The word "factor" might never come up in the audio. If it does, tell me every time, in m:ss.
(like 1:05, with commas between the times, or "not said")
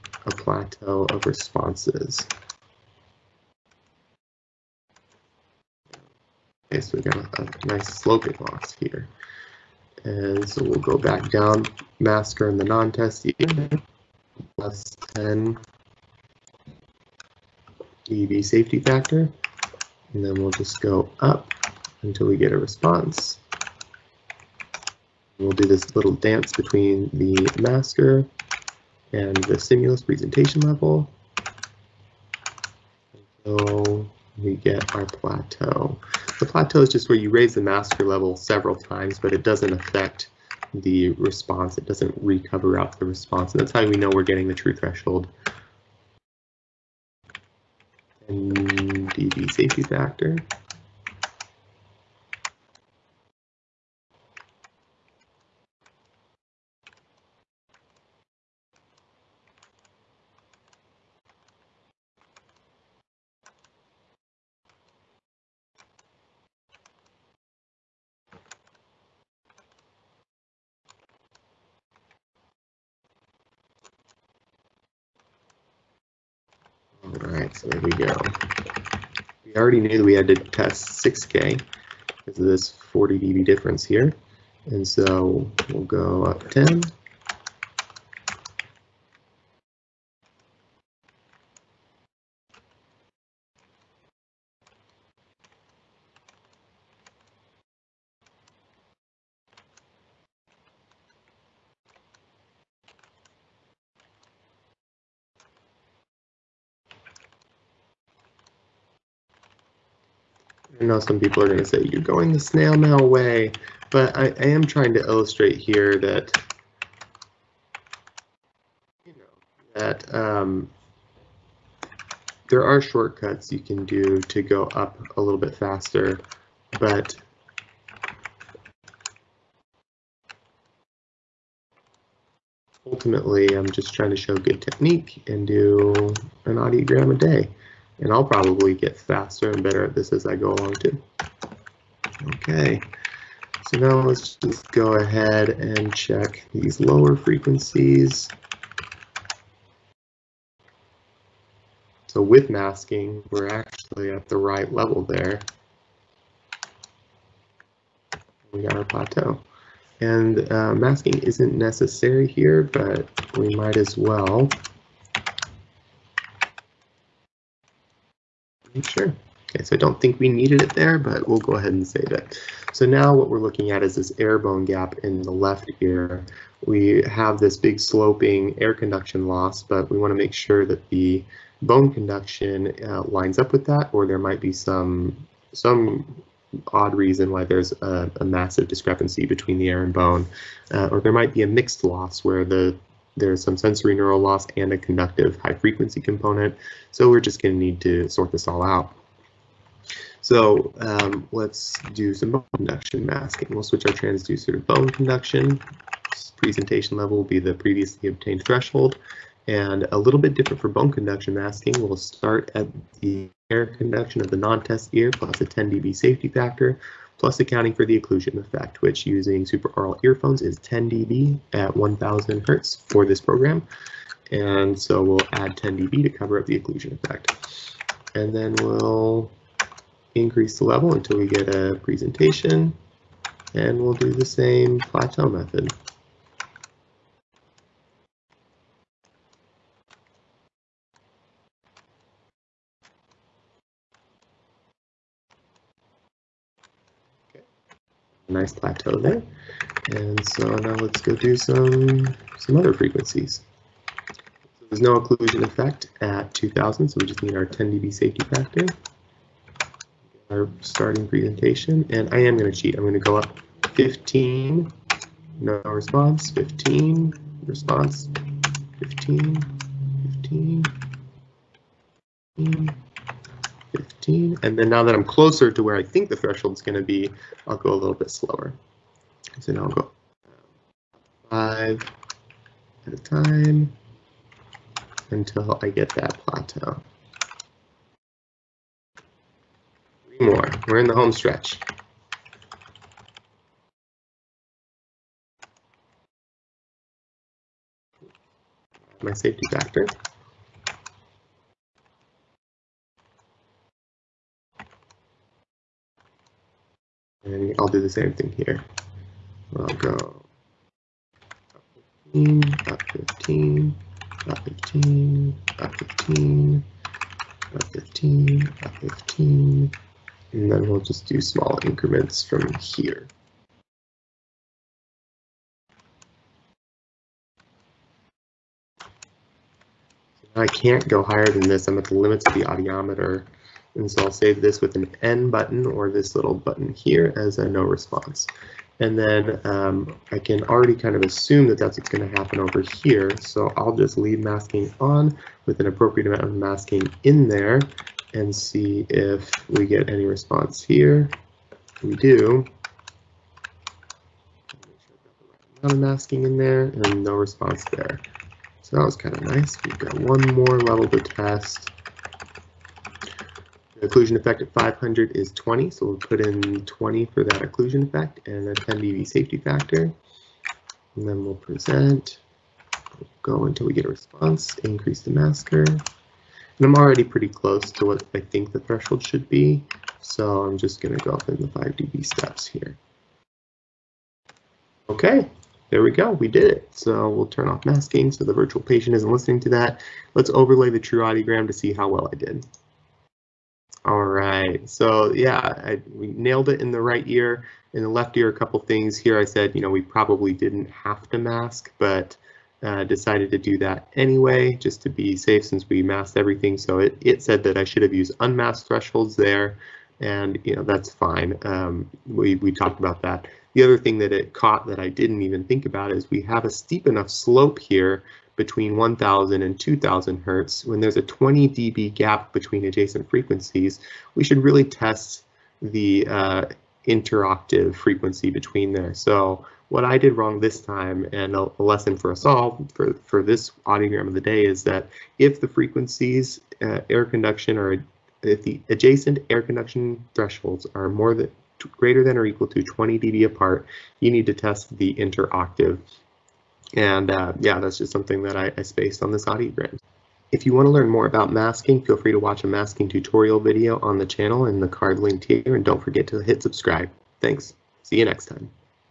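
0:18, 0:49, 3:36, 4:18, 4:59, 6:09.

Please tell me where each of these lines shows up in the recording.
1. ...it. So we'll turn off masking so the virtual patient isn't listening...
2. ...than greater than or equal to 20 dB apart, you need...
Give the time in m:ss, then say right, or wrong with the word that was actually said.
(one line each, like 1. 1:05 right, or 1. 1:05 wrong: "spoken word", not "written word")
1. 6:26 right
2. 7:21 right.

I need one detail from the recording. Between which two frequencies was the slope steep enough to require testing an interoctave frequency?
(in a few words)
1000 and 2000 hertz.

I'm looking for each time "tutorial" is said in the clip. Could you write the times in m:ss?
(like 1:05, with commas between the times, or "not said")
7:32.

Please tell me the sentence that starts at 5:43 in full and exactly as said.
So I'll just leave masking on with an appropriate amount of masking in there and see if we get any response here.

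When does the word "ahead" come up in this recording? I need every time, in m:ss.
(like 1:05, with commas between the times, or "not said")
2:24, 2:51.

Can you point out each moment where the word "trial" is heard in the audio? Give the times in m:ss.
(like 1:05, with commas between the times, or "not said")
not said.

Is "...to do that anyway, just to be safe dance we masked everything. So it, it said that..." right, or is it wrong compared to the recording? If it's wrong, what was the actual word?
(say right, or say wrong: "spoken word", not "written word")
wrong: "since", not "dance".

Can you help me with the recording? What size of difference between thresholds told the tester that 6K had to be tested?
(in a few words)
40 dB.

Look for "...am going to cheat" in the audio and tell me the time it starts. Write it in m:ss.
4:22.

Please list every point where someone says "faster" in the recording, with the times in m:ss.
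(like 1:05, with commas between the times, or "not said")
2:05, 2:18.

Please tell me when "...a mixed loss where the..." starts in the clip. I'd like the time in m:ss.
3:11.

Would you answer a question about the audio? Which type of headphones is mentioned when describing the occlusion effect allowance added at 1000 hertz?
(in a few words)
Supra-aural earphones.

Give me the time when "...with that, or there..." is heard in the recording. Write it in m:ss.
3:03.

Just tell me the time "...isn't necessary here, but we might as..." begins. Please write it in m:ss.
2:41.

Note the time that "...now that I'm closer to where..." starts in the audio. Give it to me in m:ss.
4:34.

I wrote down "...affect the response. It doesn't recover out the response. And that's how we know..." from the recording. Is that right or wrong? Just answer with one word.
right.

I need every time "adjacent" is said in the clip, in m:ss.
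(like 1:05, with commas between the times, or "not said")
7:02, 7:18.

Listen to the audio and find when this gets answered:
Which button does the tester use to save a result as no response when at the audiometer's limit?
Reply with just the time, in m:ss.
5:35.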